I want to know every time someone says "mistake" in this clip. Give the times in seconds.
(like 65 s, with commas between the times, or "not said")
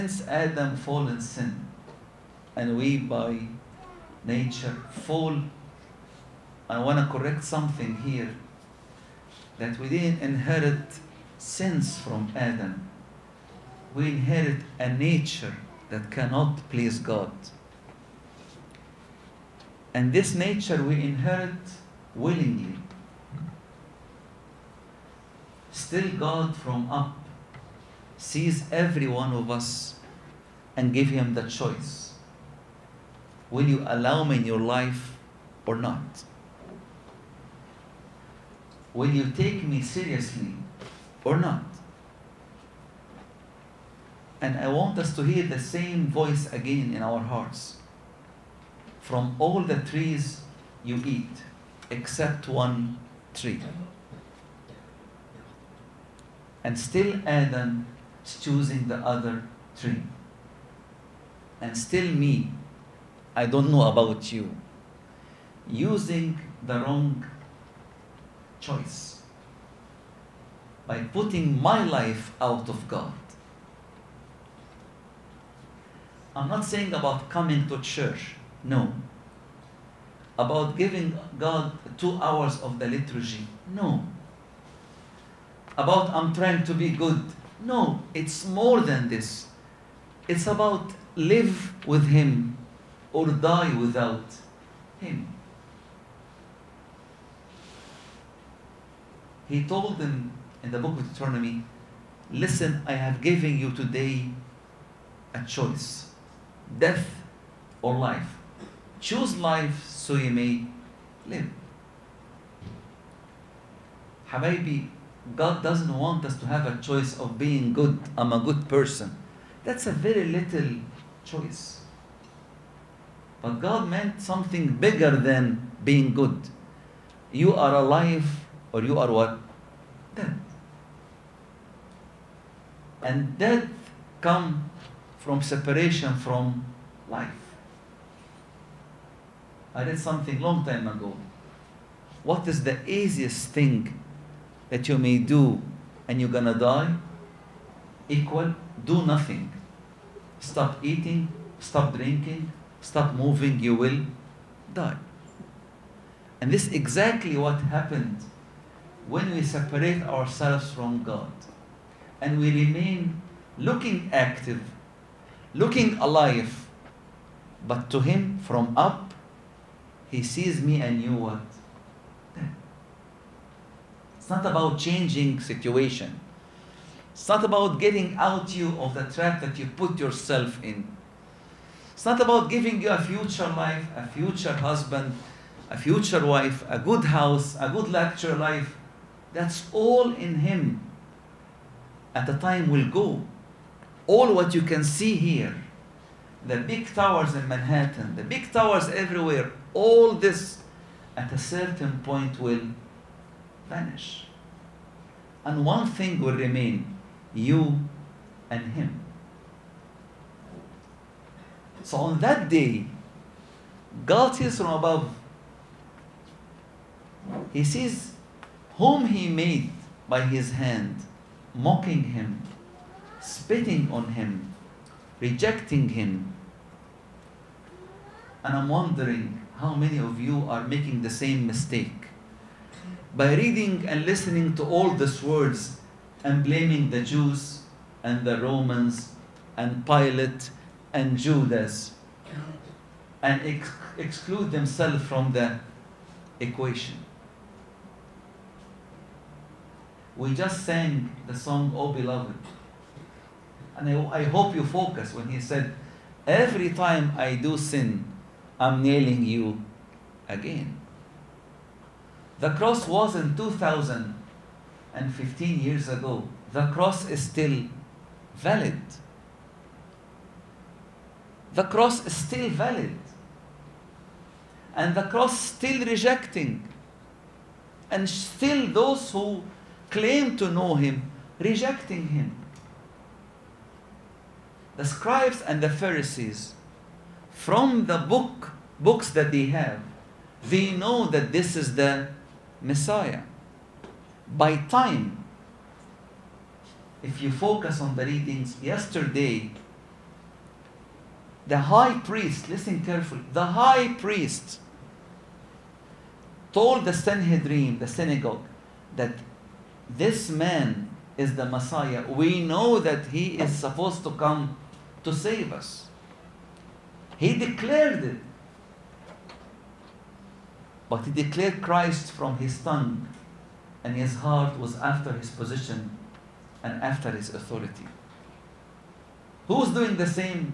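231 s.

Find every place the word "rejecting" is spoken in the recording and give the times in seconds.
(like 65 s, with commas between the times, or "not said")
225 s, 275 s, 281 s.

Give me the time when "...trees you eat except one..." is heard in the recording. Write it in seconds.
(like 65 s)
49 s.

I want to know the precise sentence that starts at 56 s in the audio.
And still Adam is choosing the other tree.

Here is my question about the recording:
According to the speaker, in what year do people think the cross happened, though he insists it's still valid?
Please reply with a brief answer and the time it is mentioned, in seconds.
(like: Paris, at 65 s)
2015, at 263 s.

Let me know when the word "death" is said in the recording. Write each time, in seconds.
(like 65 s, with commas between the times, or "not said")
106 s, 133 s.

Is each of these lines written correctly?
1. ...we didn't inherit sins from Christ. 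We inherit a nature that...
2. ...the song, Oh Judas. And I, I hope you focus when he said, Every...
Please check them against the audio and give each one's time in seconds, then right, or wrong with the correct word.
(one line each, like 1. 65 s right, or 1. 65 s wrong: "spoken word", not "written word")
1. 9 s wrong: "Adam", not "Christ"
2. 251 s wrong: "Beloved", not "Judas".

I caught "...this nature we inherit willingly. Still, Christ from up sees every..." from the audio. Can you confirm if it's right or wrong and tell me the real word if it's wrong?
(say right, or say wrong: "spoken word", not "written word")
wrong: "God", not "Christ".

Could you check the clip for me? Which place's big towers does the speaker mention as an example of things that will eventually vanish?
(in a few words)
Manhattan.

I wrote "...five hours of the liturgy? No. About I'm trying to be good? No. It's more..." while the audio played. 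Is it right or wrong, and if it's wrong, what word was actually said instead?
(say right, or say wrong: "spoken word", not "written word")
wrong: "two", not "five".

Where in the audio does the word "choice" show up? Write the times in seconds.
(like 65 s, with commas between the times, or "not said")
31 s, 68 s, 105 s, 116 s, 121 s.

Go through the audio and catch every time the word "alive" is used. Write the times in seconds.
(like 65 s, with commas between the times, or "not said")
127 s, 165 s.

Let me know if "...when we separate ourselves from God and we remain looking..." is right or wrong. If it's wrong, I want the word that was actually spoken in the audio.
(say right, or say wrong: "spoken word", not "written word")
right.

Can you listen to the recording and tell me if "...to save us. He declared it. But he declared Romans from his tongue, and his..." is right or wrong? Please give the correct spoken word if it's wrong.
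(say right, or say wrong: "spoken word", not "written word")
wrong: "Christ", not "Romans".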